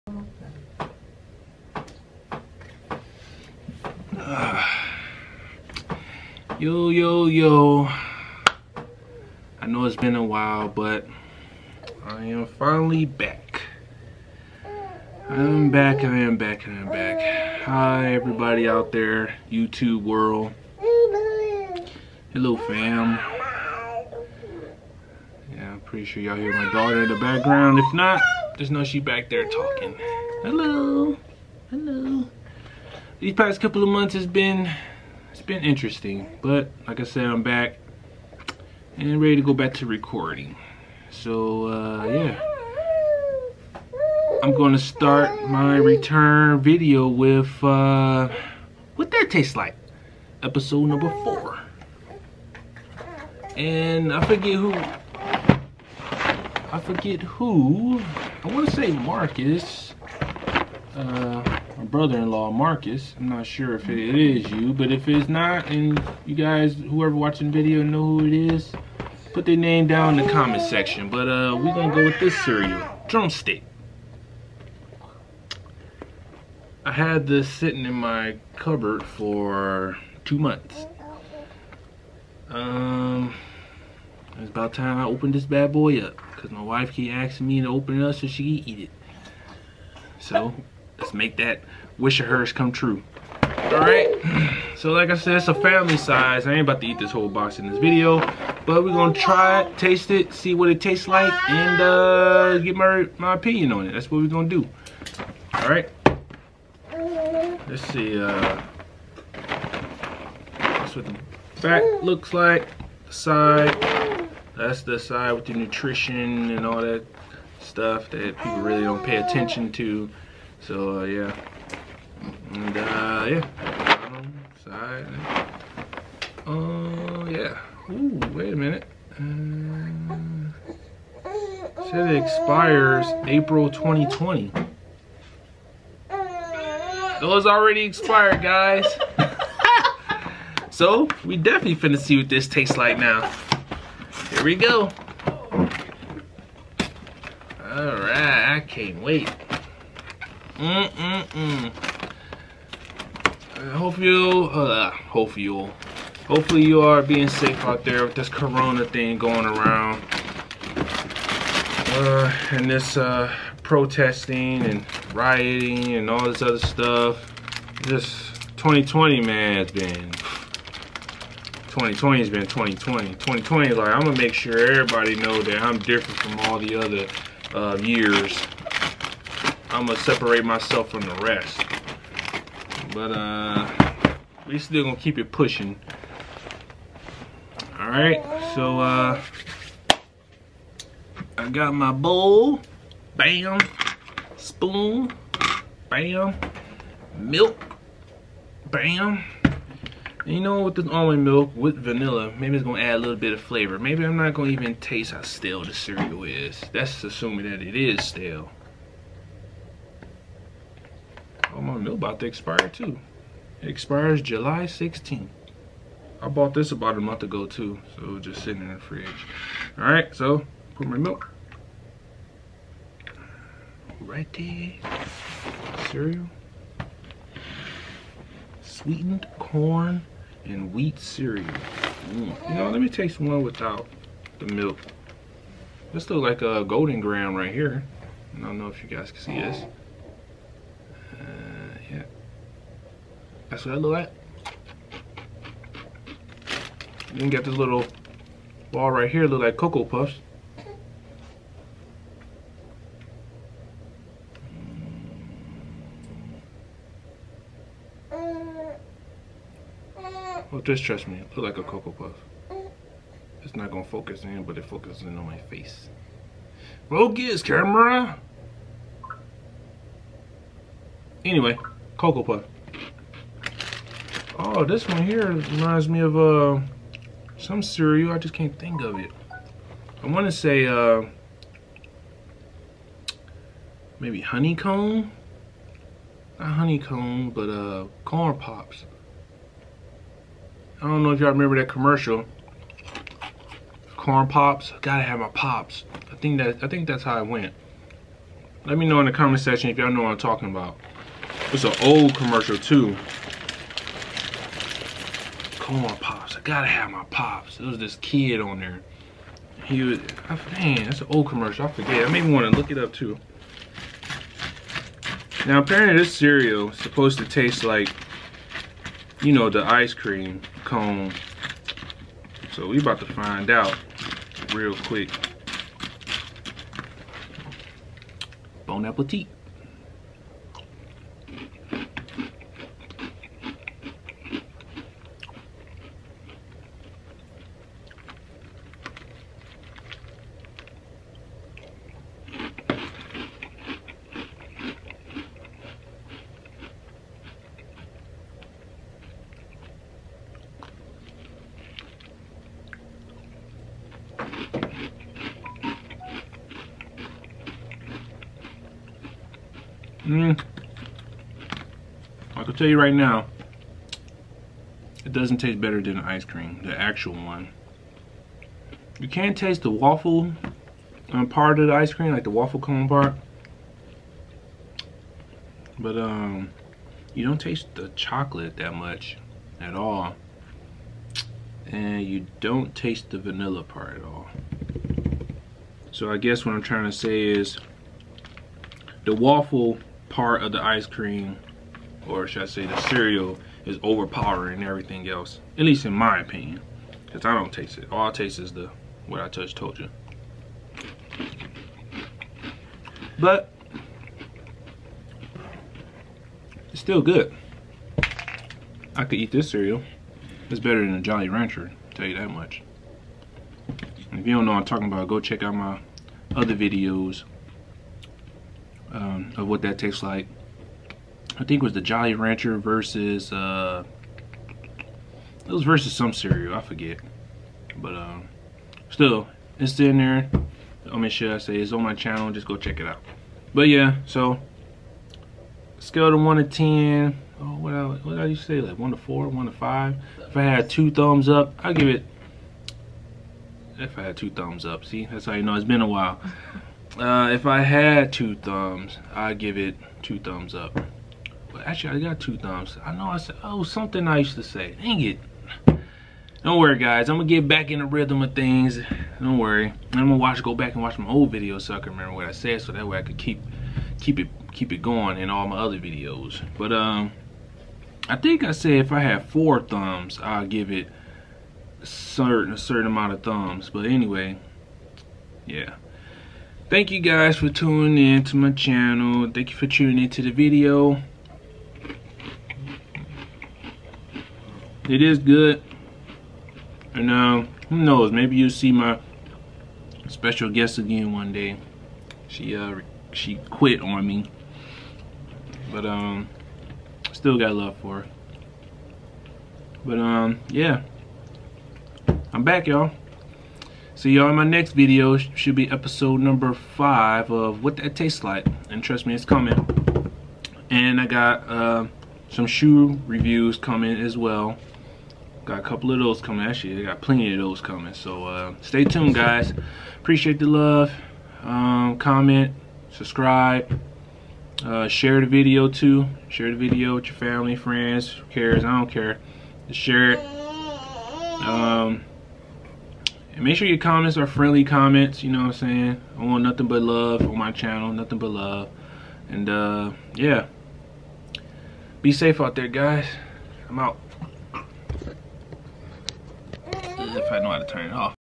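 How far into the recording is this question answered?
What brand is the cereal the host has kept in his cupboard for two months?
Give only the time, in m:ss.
1:13.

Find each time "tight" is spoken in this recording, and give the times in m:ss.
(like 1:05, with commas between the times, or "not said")
not said.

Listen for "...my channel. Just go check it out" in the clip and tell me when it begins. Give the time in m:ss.
7:11.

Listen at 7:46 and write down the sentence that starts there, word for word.
But um, I think I said if I had four thumbs, I'll give it certain a certain amount of thumbs.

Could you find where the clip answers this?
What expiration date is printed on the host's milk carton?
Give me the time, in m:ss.
3:34.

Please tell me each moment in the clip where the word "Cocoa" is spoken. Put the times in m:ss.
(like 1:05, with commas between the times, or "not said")
4:09, 4:21, 4:31.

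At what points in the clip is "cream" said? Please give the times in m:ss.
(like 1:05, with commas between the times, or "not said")
5:19, 6:06, 6:11, 6:30.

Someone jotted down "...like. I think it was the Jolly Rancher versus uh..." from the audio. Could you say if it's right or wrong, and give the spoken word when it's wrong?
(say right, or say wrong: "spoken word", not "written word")
right.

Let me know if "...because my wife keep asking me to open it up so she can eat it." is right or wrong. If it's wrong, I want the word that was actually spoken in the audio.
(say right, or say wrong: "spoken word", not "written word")
right.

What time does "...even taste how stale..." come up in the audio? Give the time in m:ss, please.
3:24.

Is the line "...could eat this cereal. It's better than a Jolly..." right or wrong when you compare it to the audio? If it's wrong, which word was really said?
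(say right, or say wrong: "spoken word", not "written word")
right.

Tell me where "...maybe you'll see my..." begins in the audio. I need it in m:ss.
8:08.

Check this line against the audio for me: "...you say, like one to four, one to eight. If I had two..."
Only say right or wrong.
wrong.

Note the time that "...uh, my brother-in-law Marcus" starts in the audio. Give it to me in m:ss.
1:00.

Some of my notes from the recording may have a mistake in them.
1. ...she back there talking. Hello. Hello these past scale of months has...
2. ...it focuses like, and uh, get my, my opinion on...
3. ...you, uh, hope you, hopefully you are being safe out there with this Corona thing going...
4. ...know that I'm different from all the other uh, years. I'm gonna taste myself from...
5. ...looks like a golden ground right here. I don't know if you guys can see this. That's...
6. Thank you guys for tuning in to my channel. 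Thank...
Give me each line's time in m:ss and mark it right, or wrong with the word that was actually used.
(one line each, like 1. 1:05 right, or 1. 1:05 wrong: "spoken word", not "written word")
1. 0:28 wrong: "couple", not "scale"
2. 1:40 wrong: "tastes", not "focuses"
3. 2:33 right
4. 2:55 wrong: "separate", not "taste"
5. 3:56 right
6. 7:56 right.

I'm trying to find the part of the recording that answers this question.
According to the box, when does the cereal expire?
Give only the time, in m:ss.
2:13.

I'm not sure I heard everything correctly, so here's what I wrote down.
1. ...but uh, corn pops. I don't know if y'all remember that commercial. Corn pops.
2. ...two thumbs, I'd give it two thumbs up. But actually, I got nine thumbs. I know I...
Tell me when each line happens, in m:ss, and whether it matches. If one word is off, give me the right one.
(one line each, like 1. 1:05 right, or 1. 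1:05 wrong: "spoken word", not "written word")
1. 4:47 right
2. 7:28 wrong: "two", not "nine".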